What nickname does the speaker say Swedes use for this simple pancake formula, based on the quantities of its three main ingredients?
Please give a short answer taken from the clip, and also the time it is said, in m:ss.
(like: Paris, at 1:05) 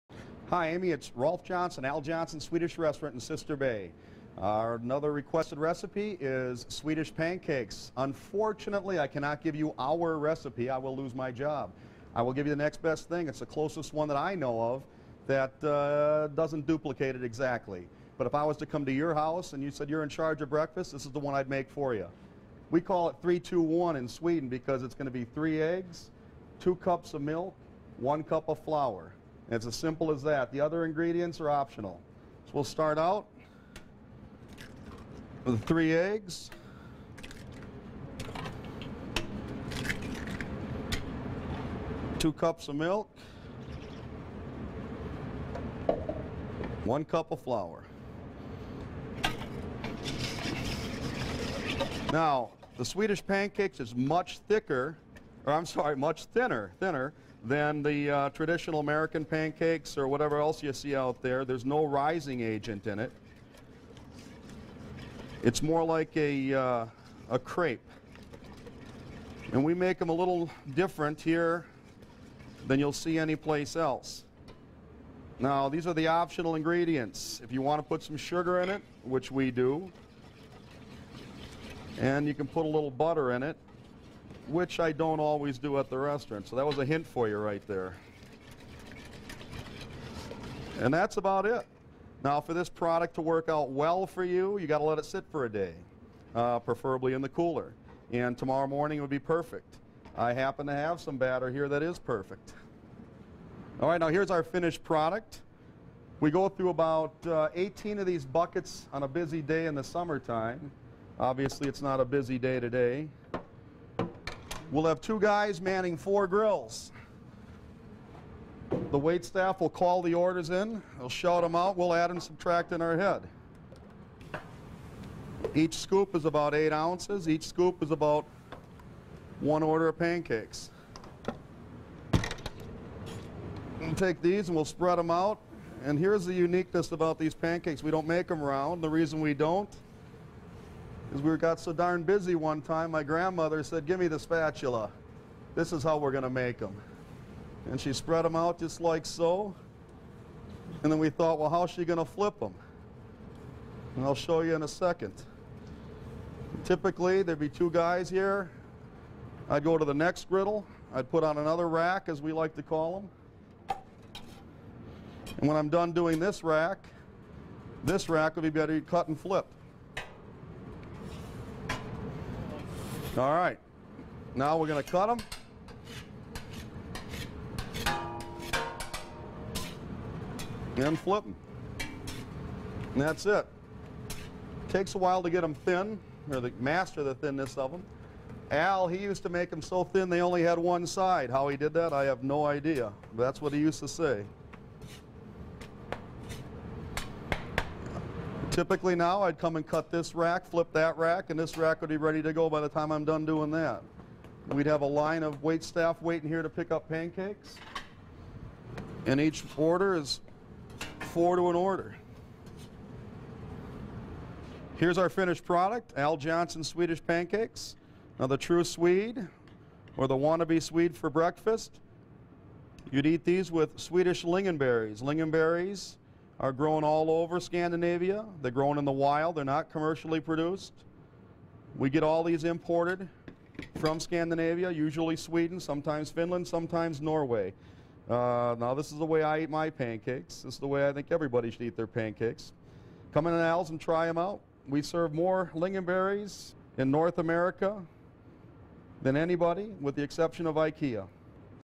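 321, at 0:23.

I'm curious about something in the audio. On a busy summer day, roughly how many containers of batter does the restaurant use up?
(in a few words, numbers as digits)
18.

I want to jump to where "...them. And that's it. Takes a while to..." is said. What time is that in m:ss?
3:01.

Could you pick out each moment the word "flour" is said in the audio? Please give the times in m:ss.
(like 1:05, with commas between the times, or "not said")
0:28, 0:47.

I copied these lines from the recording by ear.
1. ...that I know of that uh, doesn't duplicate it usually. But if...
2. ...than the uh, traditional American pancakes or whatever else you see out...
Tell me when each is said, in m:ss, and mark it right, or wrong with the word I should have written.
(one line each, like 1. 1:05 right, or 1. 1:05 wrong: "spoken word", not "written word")
1. 0:14 wrong: "exactly", not "usually"
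2. 0:57 right.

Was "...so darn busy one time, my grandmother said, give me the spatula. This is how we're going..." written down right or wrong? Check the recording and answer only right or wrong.
right.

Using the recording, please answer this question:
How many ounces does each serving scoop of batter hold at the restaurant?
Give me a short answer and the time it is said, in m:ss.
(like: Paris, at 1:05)
8, at 2:06.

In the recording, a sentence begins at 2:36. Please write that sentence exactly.
Typically, there'd be two guys here.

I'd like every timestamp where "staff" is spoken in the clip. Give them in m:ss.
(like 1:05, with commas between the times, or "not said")
1:59, 3:25.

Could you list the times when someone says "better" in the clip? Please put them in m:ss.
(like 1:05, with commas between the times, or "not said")
2:48.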